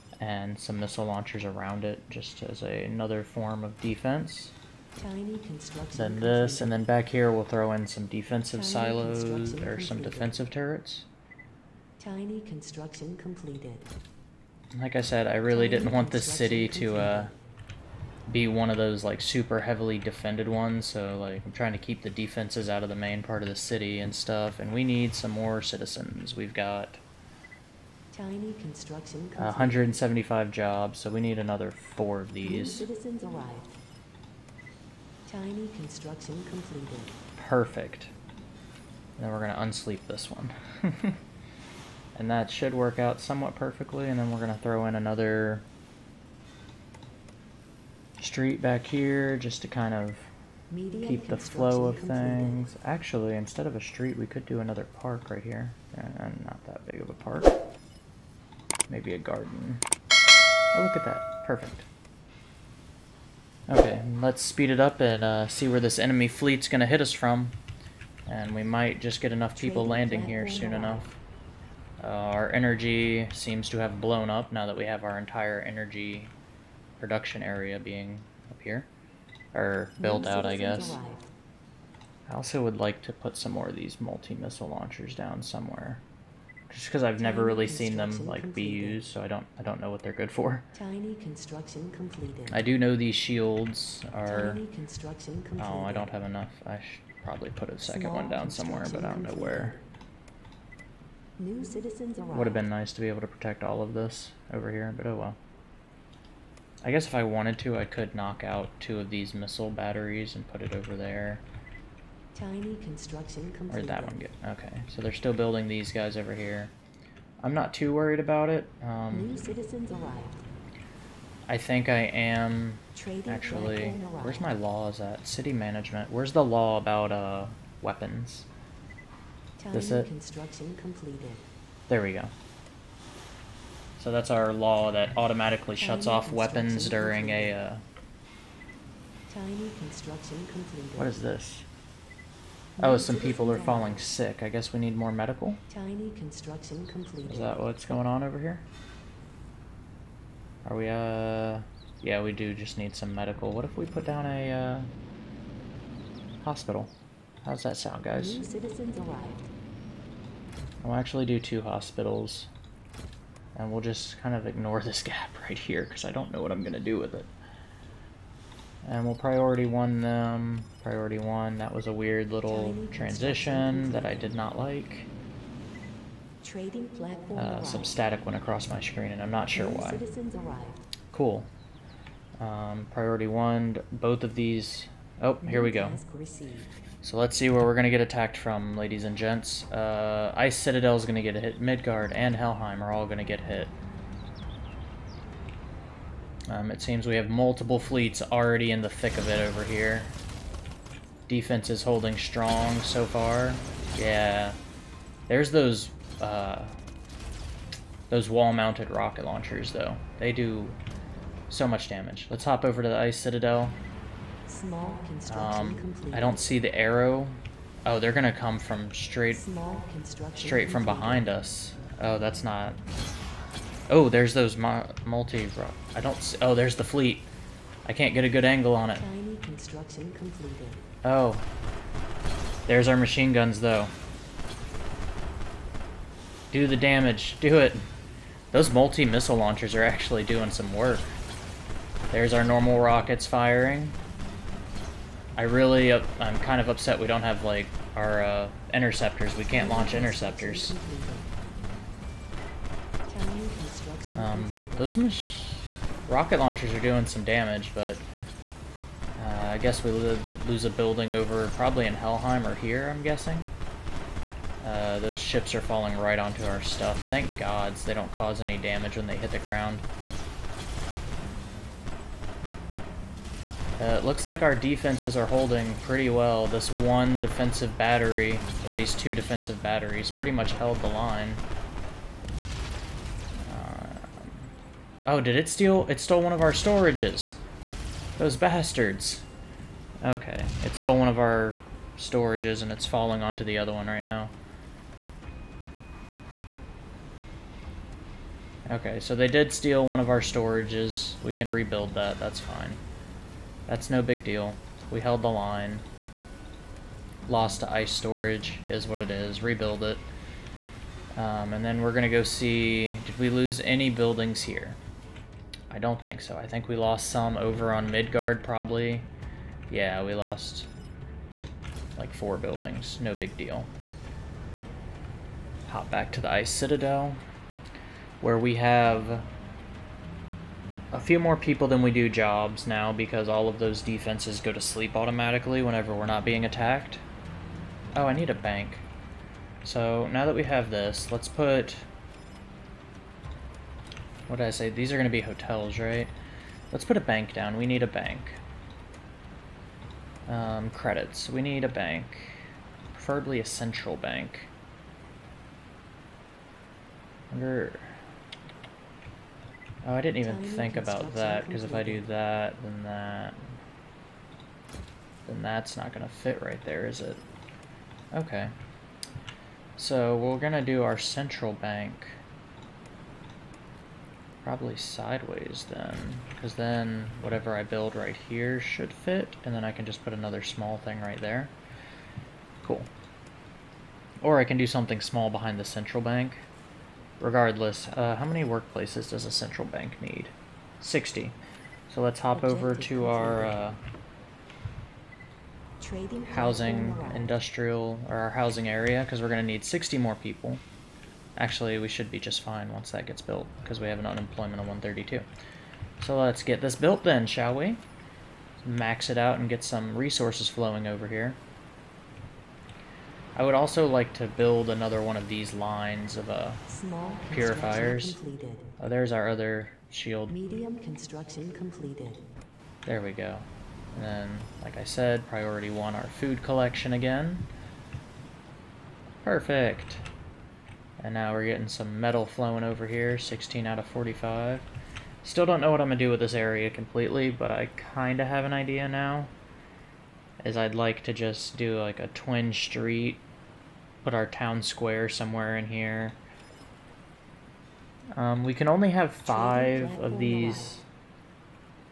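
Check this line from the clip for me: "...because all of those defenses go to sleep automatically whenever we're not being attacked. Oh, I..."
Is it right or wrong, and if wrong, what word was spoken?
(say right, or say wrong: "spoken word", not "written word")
right.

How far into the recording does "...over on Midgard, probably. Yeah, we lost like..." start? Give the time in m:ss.
5:17.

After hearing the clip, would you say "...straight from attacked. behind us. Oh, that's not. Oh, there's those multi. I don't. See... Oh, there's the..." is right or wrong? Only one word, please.
wrong.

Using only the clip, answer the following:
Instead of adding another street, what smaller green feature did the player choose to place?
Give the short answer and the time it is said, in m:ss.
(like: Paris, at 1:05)
A garden, at 0:58.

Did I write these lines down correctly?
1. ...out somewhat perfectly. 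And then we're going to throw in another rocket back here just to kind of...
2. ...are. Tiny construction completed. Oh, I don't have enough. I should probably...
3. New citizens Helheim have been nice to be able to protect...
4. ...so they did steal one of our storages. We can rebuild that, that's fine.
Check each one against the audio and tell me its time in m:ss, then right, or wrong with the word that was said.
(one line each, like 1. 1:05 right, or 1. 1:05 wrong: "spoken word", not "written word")
1. 0:42 wrong: "street", not "rocket"
2. 1:34 right
3. 1:41 wrong: "Would", not "Helheim"
4. 4:58 right.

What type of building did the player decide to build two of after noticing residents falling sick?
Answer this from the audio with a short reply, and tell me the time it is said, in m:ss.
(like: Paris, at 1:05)
Hospital, at 2:36.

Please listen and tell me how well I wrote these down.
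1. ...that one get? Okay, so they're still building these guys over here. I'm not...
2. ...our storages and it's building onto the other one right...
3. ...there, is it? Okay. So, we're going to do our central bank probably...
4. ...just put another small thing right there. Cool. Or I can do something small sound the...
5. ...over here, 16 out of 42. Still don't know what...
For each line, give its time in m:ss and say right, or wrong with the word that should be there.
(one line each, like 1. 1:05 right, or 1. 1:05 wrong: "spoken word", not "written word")
1. 1:53 right
2. 4:51 wrong: "falling", not "building"
3. 6:06 right
4. 6:19 wrong: "behind", not "sound"
5. 7:12 wrong: "45", not "42".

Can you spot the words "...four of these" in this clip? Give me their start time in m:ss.
0:31.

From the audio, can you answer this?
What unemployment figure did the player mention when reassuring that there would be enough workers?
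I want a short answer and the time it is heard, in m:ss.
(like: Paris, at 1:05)
132, at 6:44.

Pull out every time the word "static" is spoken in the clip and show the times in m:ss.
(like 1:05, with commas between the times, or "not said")
2:57.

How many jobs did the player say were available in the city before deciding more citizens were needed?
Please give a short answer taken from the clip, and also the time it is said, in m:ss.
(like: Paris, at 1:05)
175, at 0:28.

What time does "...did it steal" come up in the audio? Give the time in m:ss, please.
4:45.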